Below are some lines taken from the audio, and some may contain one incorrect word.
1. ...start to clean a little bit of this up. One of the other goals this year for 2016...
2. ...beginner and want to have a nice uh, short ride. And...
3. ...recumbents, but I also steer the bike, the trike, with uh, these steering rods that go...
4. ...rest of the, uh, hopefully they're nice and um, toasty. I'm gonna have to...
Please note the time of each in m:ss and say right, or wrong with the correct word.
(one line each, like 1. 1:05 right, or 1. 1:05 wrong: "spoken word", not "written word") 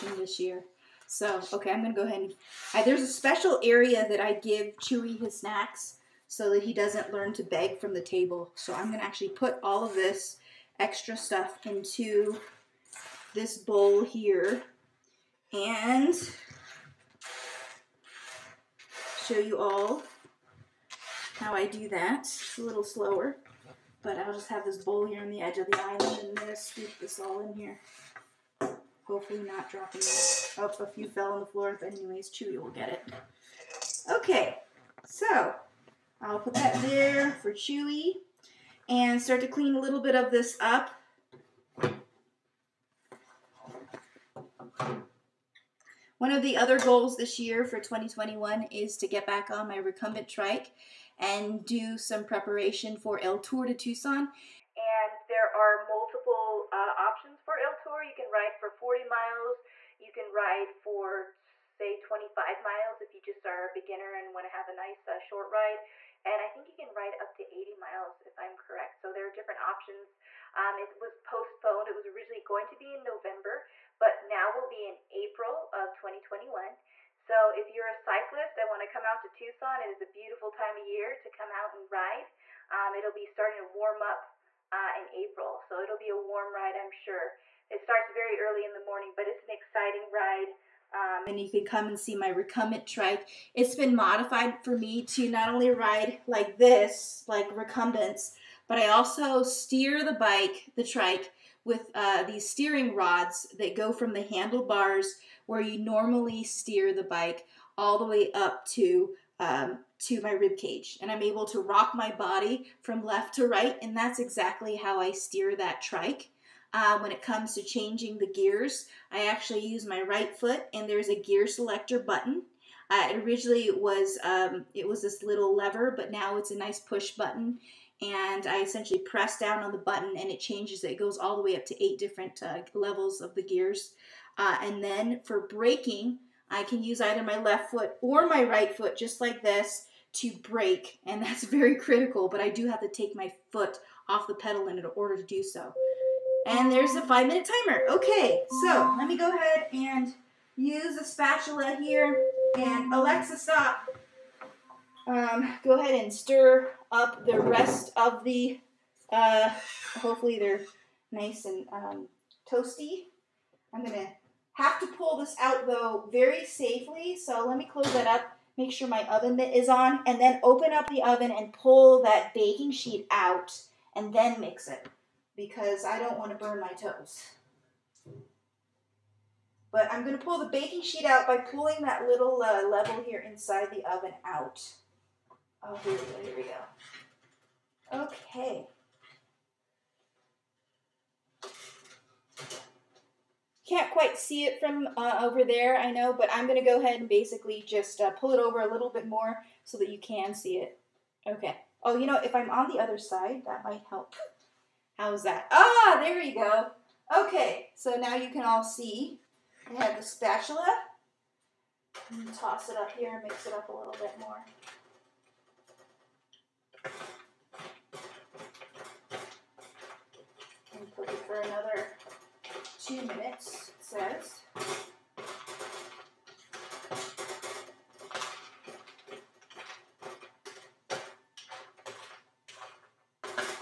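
1. 0:39 wrong: "2021", not "2016"
2. 1:03 right
3. 1:37 right
4. 2:37 right.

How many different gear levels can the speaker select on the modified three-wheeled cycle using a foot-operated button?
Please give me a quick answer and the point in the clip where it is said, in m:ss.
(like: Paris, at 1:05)
8, at 2:11.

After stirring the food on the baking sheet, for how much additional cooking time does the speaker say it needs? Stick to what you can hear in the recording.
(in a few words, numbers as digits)
2 minutes.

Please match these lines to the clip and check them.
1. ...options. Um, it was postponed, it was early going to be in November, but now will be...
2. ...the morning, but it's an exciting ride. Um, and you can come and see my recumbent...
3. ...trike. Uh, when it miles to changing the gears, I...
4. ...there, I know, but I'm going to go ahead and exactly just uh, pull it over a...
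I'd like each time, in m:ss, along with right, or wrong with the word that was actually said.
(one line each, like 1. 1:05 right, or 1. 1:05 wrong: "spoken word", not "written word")
1. 1:09 wrong: "originally", not "early"
2. 1:28 right
3. 1:55 wrong: "comes", not "miles"
4. 3:15 wrong: "basically", not "exactly".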